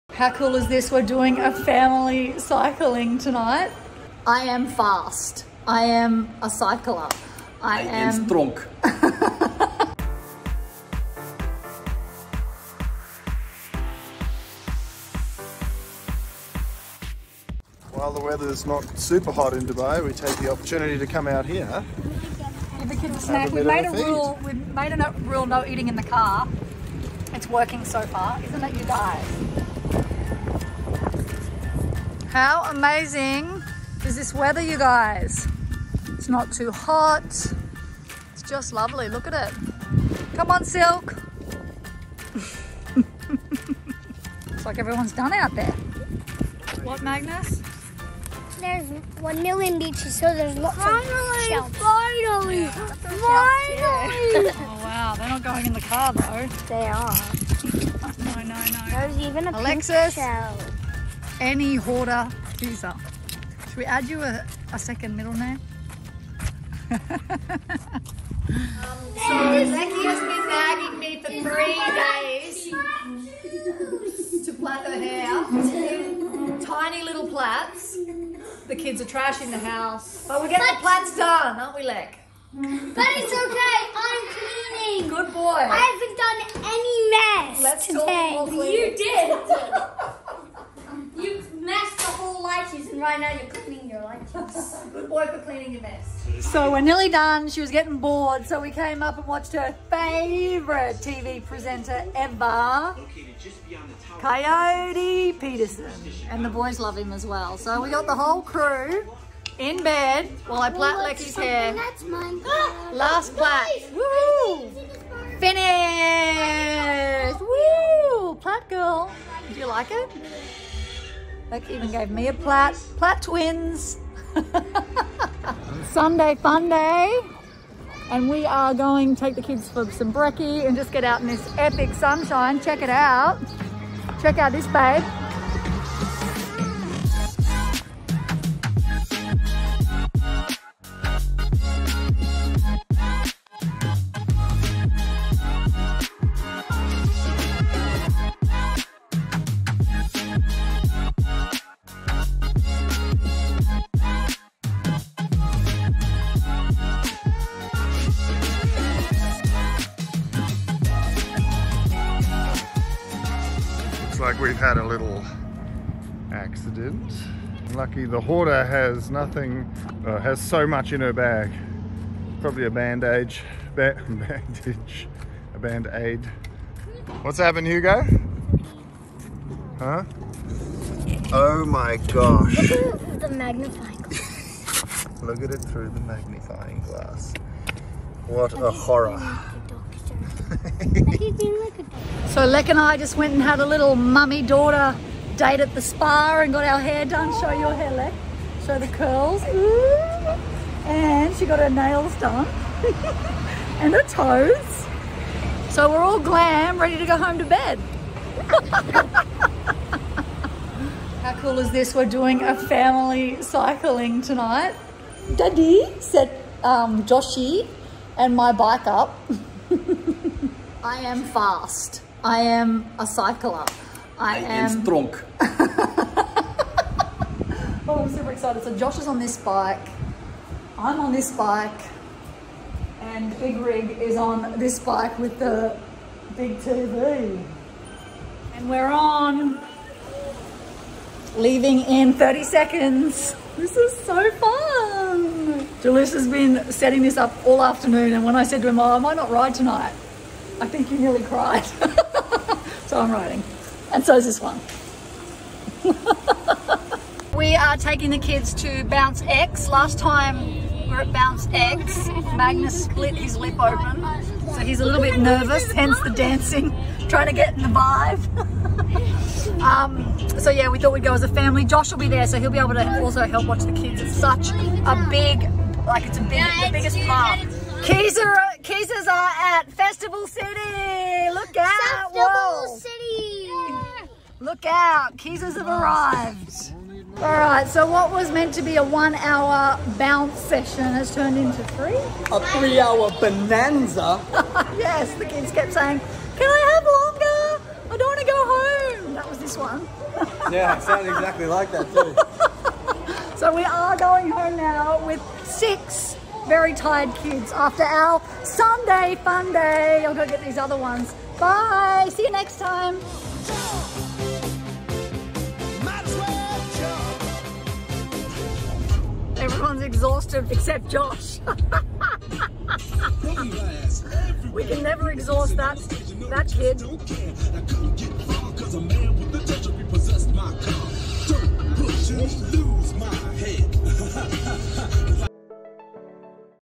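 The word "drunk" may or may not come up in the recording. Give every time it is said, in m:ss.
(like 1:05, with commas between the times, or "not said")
3:44.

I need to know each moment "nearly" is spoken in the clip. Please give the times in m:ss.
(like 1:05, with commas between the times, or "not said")
1:36, 4:10.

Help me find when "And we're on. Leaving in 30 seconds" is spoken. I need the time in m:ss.
3:58.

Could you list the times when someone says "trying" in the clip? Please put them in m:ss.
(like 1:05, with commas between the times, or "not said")
4:27.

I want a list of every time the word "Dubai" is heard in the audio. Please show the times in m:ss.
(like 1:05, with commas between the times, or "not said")
0:19.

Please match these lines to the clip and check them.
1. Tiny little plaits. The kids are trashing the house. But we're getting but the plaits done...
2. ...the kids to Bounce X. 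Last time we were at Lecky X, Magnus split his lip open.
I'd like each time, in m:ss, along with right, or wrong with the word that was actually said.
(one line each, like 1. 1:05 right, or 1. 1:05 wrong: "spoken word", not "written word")
1. 1:16 right
2. 4:18 wrong: "Bounce", not "Lecky".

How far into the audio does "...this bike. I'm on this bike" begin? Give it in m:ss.
3:49.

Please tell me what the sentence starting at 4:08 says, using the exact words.
And when I said to him, oh, I might not ride tonight.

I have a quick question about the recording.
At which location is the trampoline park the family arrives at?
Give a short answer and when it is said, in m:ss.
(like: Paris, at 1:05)
Festival City, at 4:39.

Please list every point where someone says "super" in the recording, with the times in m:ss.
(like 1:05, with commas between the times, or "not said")
0:18, 3:48.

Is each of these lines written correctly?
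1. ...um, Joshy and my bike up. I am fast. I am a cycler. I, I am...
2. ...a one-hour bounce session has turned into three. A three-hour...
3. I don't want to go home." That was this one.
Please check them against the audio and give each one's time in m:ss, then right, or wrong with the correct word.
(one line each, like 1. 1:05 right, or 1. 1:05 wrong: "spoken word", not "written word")
1. 3:36 right
2. 4:48 right
3. 4:57 right.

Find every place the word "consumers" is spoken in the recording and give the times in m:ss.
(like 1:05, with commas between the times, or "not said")
not said.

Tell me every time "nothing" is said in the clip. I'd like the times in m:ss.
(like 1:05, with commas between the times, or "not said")
2:49.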